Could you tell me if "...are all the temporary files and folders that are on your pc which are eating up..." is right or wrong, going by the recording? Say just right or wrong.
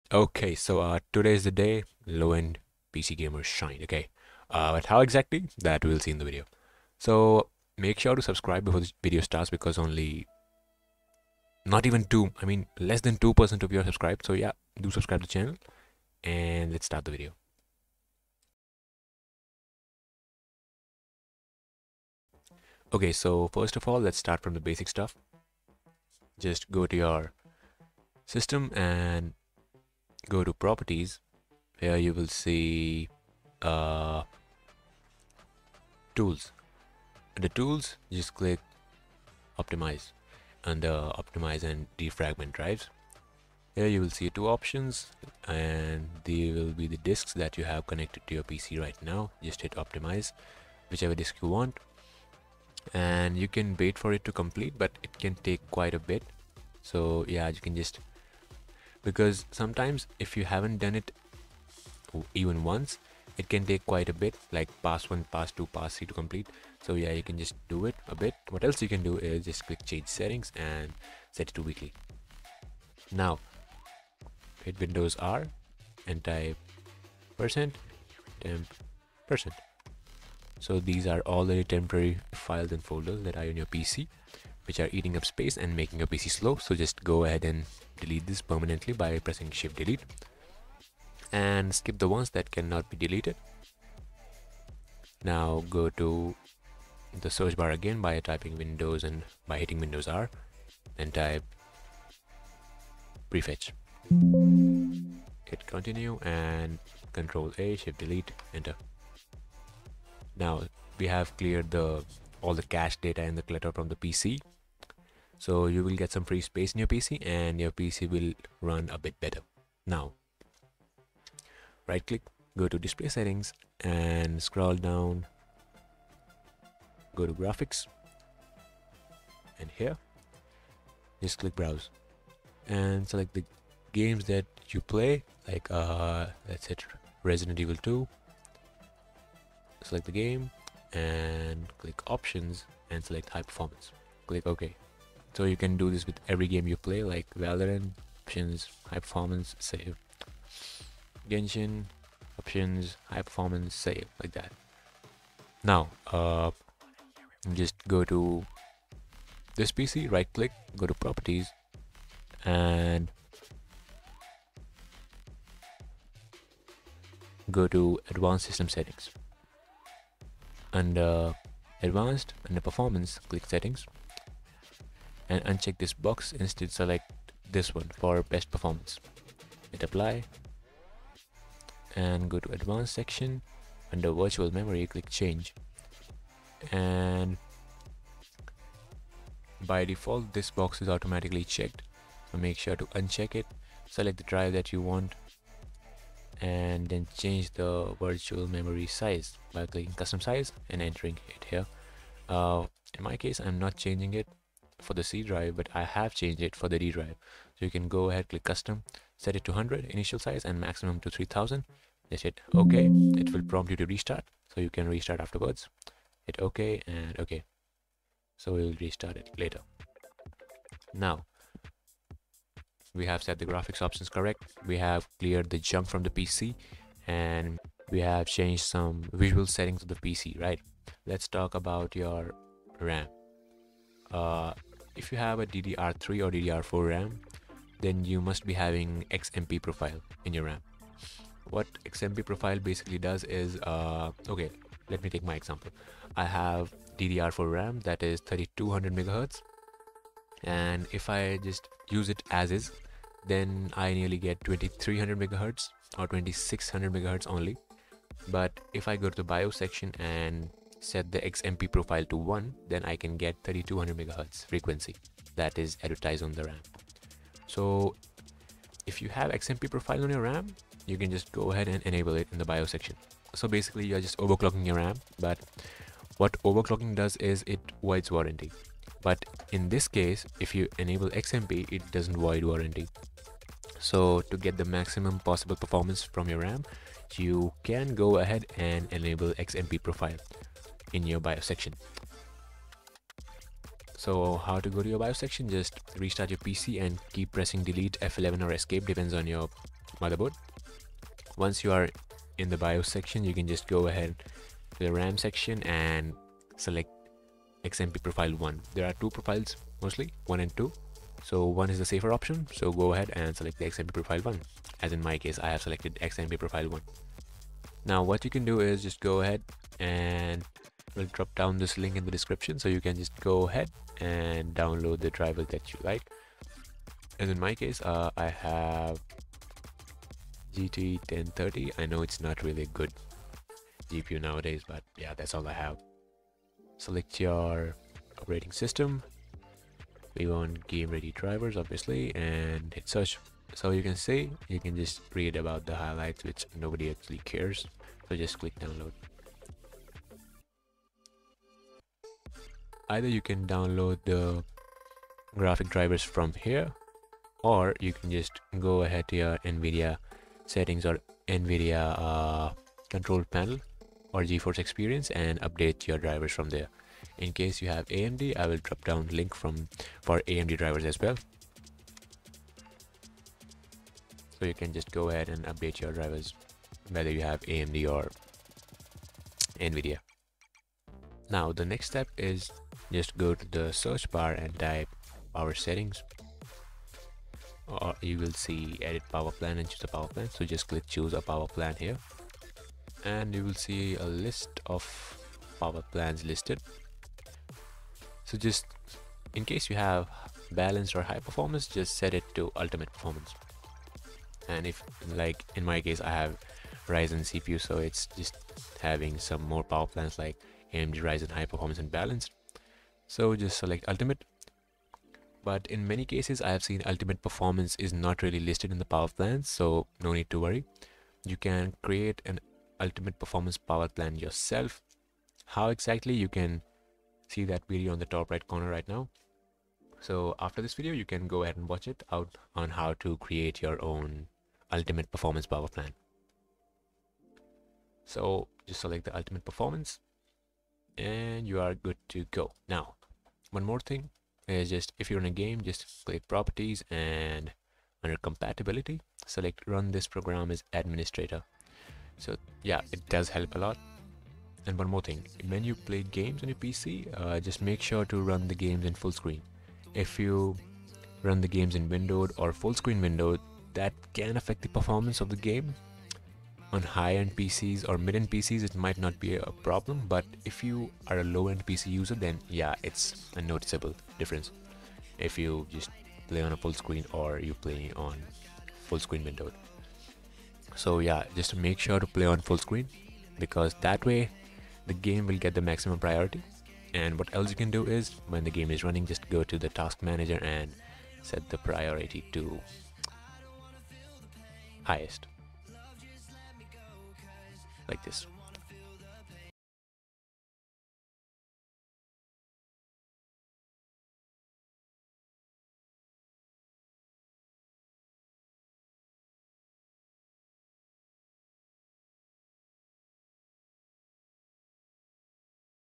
right.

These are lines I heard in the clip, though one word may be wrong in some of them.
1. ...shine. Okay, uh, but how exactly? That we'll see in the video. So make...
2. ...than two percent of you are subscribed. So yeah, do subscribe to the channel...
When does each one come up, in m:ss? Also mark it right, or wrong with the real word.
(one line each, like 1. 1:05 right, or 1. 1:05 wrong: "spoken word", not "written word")
1. 0:03 right
2. 0:12 right.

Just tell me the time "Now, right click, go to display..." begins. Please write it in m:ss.
1:59.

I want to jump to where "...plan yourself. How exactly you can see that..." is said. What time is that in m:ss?
7:03.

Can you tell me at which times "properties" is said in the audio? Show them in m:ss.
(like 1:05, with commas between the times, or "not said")
0:30, 2:40, 7:26.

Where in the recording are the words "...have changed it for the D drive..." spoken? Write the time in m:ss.
3:25.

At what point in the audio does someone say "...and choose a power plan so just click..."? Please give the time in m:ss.
6:29.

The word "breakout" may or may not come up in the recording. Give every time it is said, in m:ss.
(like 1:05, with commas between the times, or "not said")
not said.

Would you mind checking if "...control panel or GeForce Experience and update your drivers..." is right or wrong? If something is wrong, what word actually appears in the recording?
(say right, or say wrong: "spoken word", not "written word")
right.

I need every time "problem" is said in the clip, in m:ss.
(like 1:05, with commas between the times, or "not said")
7:49.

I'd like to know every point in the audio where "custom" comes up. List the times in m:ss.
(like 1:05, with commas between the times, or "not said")
3:19, 3:28.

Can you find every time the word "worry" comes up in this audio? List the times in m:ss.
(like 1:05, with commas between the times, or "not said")
7:00.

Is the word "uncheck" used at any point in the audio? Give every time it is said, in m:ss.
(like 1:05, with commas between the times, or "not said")
2:55, 3:12.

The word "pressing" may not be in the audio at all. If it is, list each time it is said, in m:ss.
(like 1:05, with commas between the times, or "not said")
1:29, 4:57.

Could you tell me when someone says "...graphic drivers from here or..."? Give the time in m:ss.
5:55.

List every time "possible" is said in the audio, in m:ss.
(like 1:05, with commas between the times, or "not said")
4:45.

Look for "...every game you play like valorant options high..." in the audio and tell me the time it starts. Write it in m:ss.
2:26.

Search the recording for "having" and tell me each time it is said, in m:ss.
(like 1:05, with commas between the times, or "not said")
3:58, 6:48.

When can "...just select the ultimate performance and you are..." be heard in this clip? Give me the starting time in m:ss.
7:18.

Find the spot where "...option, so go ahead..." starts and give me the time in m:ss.
5:12.